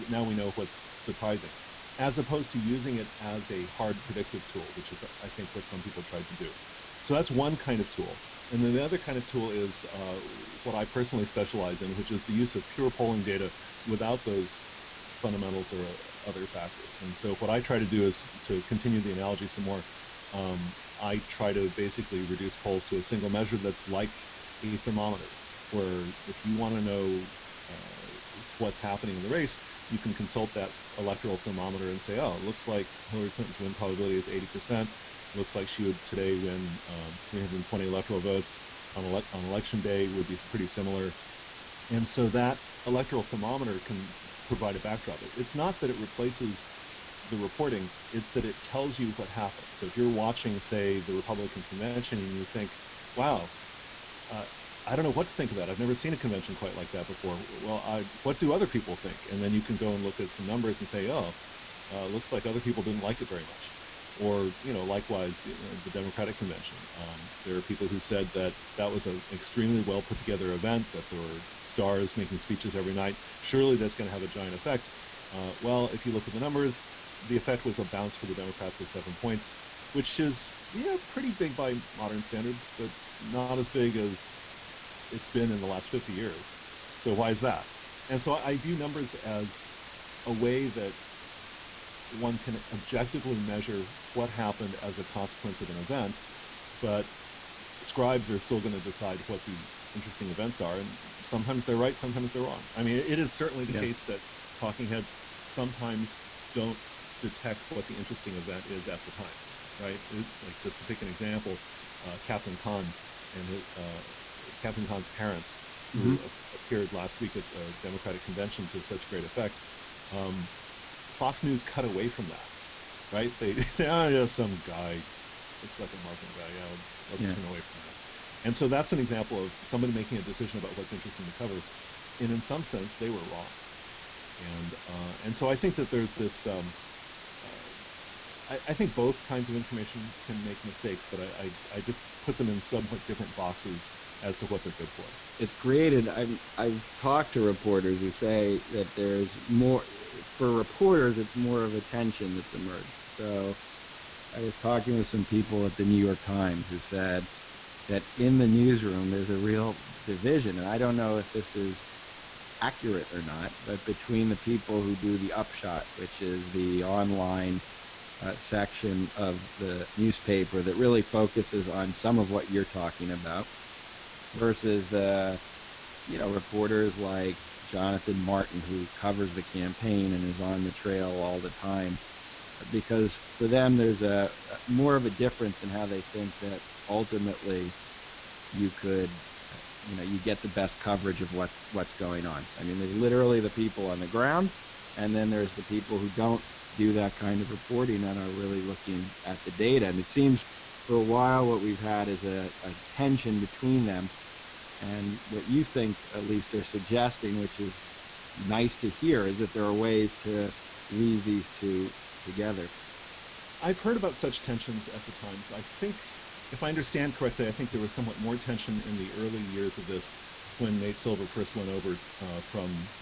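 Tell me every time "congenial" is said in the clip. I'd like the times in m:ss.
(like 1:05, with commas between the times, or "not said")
not said.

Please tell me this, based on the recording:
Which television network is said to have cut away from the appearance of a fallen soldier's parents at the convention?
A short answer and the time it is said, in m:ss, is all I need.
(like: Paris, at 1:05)
Fox News, at 2:01.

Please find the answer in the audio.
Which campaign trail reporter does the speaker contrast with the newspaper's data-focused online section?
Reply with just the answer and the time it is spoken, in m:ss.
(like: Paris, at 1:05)
Jonathan Martin, at 2:57.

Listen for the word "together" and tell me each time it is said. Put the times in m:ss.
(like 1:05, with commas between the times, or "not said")
1:10, 3:32.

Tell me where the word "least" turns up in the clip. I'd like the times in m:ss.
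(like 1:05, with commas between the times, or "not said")
3:26.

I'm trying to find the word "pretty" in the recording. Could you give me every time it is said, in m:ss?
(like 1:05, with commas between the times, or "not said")
0:40, 1:21.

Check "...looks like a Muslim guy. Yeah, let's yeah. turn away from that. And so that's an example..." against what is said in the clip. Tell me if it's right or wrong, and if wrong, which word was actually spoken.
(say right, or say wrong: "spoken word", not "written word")
right.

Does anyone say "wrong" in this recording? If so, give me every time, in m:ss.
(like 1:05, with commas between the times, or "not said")
1:42, 2:13.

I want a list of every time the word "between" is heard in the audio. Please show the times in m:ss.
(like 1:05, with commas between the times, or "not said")
2:43, 3:23.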